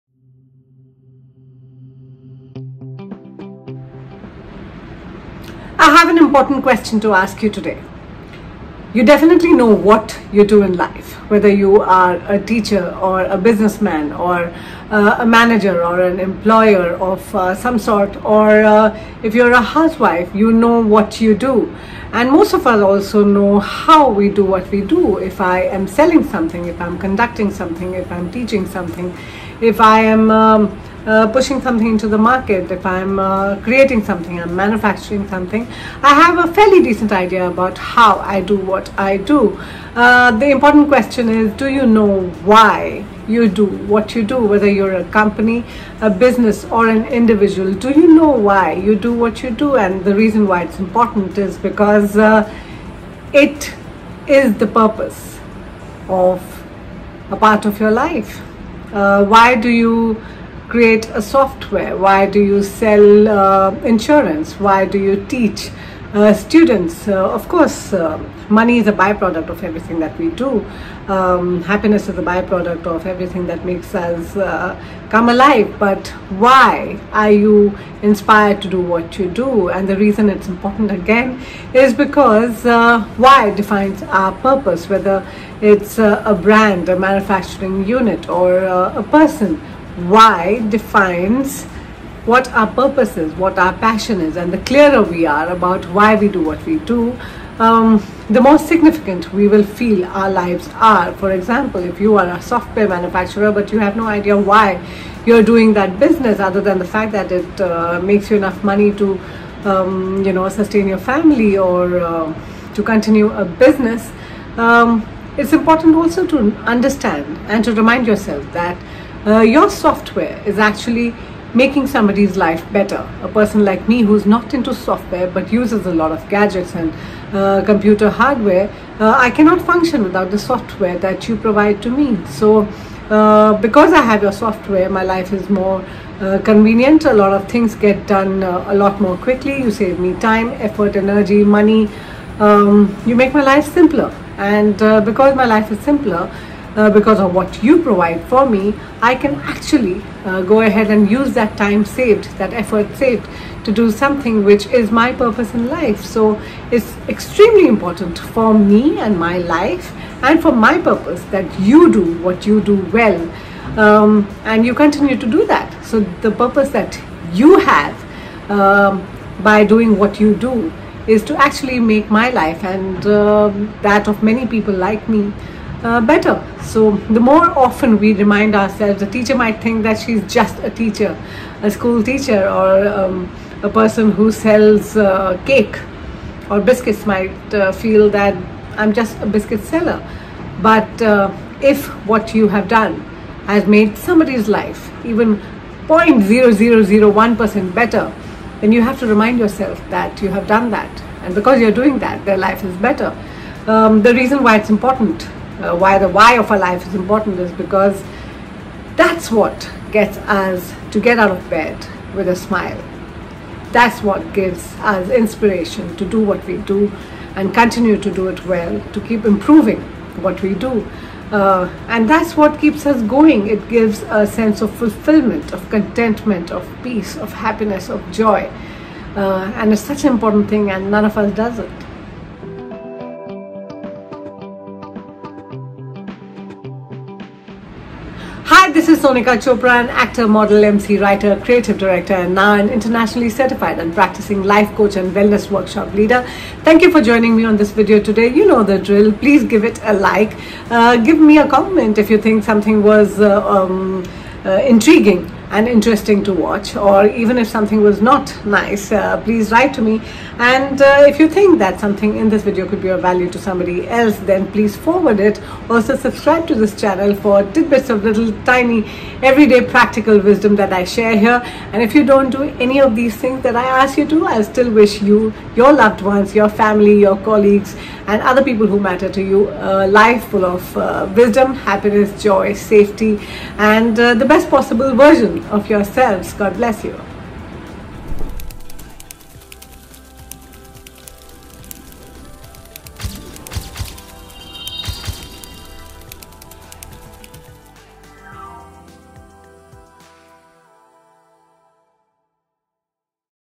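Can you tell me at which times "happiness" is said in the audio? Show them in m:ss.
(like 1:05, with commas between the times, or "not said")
1:11, 3:47, 4:41.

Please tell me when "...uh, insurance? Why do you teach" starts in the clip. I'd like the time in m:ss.
1:03.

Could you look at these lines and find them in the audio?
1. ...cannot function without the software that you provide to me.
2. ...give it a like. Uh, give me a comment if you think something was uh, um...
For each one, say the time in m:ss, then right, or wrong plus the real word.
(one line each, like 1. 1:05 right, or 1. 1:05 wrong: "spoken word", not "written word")
1. 2:09 right
2. 4:09 right.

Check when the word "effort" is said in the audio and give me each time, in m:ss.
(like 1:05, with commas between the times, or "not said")
2:20, 2:32.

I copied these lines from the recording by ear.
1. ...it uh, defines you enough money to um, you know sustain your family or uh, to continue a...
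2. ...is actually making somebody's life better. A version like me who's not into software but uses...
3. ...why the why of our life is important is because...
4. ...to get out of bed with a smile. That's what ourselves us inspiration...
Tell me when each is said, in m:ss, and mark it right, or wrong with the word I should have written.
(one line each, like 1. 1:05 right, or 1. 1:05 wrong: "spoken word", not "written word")
1. 1:47 wrong: "makes", not "defines"
2. 2:00 wrong: "person", not "version"
3. 3:25 right
4. 3:30 wrong: "gives", not "ourselves".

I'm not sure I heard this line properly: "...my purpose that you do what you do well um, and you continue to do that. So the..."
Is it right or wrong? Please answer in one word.
right.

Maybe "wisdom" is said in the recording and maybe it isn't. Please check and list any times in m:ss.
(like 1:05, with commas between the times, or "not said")
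4:30, 4:41.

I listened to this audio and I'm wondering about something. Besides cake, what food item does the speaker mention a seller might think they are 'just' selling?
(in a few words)
biscuits.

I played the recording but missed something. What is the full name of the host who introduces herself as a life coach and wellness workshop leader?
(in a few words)
Sonika Chopra.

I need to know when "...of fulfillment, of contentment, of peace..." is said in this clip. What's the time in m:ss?
3:44.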